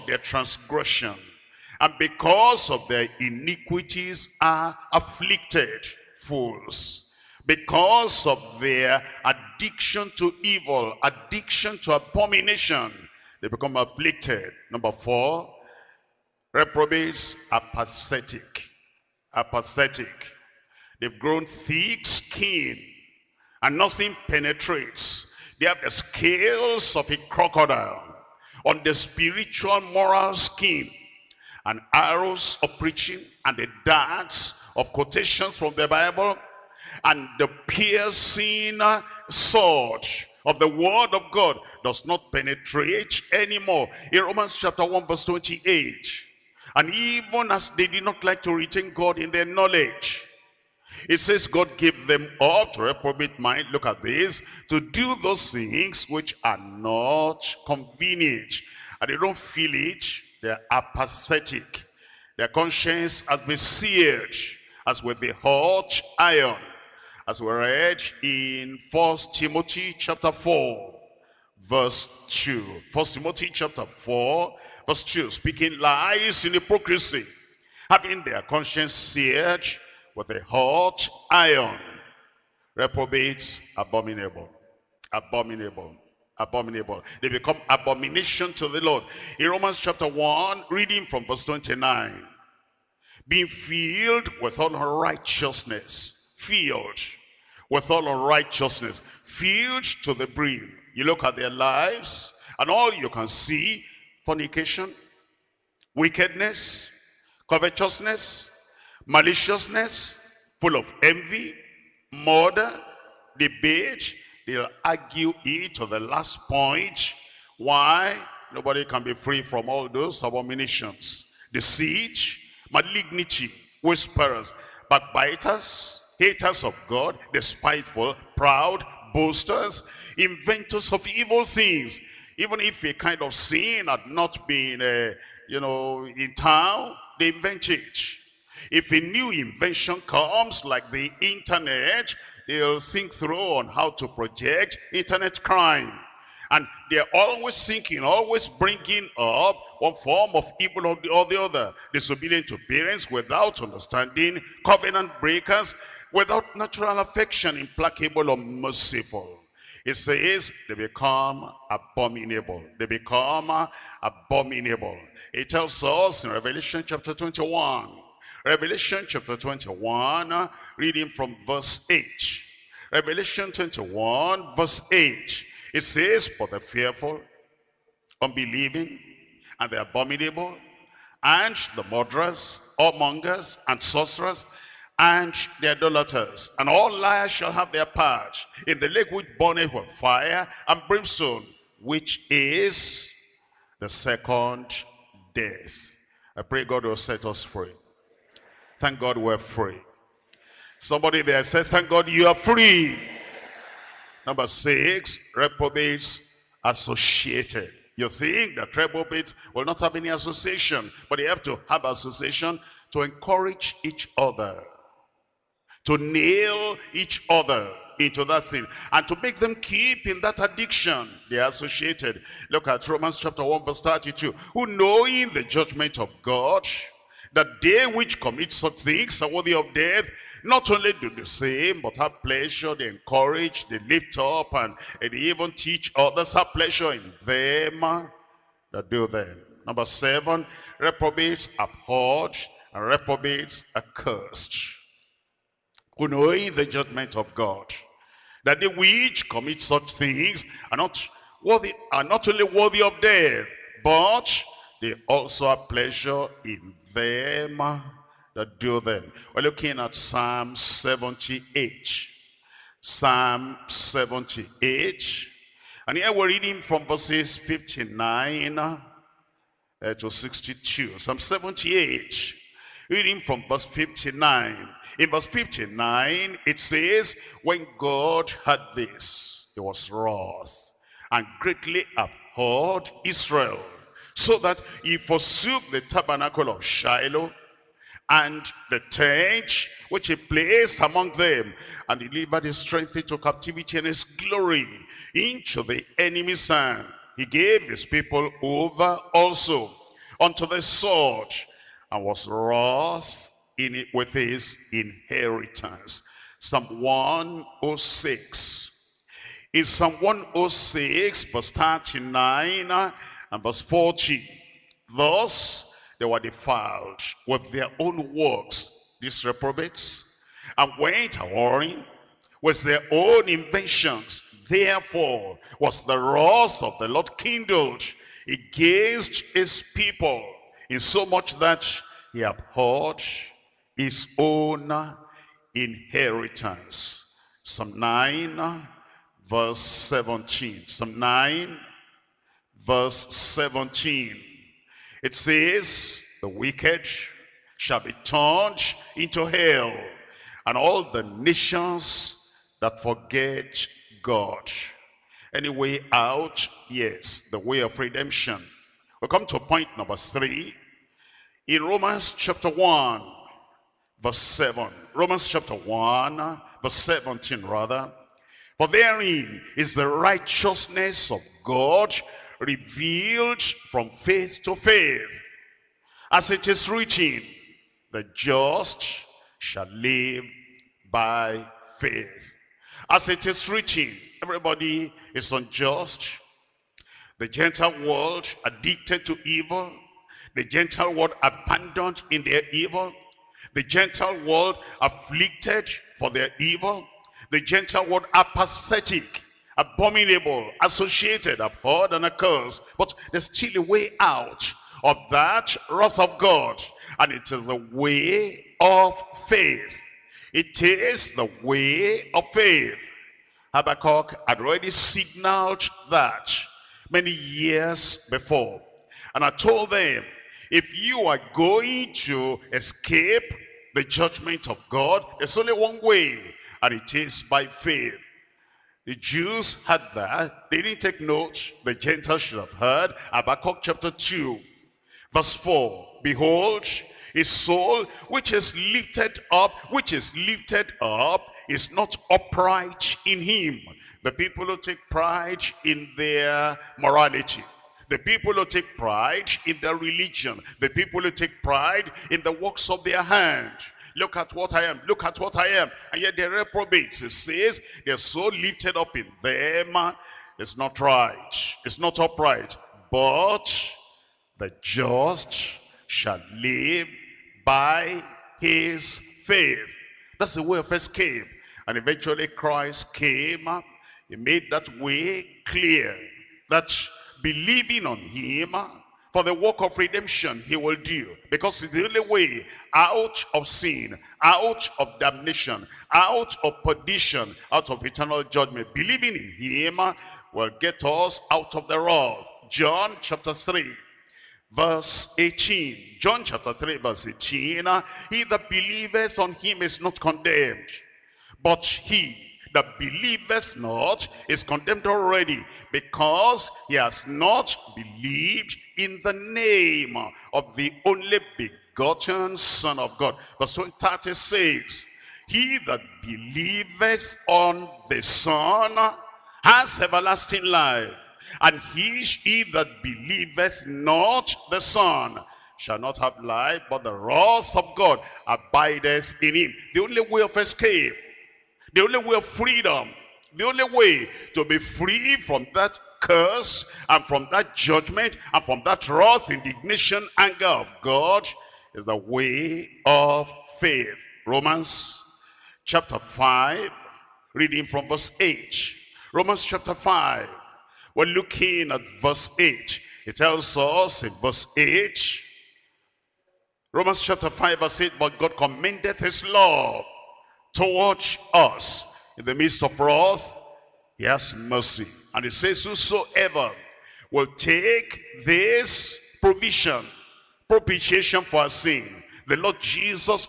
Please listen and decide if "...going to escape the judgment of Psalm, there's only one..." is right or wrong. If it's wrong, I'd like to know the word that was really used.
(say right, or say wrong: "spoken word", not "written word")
wrong: "God", not "Psalm".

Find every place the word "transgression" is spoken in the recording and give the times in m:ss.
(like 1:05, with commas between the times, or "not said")
0:00.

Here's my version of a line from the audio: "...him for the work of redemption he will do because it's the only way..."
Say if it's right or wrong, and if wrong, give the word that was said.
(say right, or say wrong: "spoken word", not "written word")
right.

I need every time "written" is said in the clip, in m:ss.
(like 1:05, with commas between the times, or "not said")
6:16, 6:23.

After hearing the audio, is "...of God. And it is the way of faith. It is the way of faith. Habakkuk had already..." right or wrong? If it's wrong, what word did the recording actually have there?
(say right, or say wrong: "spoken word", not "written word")
right.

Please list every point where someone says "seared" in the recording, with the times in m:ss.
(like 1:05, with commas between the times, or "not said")
1:03, 1:18.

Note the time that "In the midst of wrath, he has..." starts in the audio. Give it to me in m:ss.
9:22.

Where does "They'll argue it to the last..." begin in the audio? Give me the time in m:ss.
1:54.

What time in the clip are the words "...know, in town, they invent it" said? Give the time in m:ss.
2:15.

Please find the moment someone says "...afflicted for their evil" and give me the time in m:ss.
6:34.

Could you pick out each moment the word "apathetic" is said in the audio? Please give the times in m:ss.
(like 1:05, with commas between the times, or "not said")
0:19, 1:00, 6:38.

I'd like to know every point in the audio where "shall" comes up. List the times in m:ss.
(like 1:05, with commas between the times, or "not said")
3:07, 5:47, 6:19, 7:45, 8:45.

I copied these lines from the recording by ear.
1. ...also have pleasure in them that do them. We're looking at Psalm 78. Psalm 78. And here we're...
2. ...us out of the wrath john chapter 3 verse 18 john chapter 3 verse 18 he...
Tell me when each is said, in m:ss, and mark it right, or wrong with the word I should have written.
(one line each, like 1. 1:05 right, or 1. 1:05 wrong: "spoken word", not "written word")
1. 4:15 right
2. 8:10 right.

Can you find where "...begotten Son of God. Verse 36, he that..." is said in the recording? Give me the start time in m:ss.
8:31.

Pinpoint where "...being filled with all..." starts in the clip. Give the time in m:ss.
1:33.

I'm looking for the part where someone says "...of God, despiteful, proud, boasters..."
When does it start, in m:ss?
2:06.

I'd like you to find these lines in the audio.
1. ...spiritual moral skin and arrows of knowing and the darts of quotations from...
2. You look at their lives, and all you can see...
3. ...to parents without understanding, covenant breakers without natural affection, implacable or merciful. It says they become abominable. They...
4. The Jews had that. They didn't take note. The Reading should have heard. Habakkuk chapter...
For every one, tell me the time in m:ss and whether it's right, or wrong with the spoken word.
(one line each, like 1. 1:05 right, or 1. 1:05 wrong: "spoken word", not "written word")
1. 0:28 wrong: "preaching", not "knowing"
2. 1:40 right
3. 2:32 right
4. 7:08 wrong: "Gentiles", not "Reading".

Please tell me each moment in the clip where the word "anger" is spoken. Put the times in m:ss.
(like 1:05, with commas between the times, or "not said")
9:00.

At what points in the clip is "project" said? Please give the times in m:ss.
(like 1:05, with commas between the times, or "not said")
2:24.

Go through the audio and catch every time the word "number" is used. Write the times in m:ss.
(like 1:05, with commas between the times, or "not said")
0:14, 3:24, 3:59, 5:59.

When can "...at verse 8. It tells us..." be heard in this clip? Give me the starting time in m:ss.
9:11.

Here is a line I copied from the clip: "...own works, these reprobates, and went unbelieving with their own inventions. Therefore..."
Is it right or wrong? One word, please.
wrong.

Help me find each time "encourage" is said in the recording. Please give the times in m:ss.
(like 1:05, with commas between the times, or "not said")
3:33, 3:52.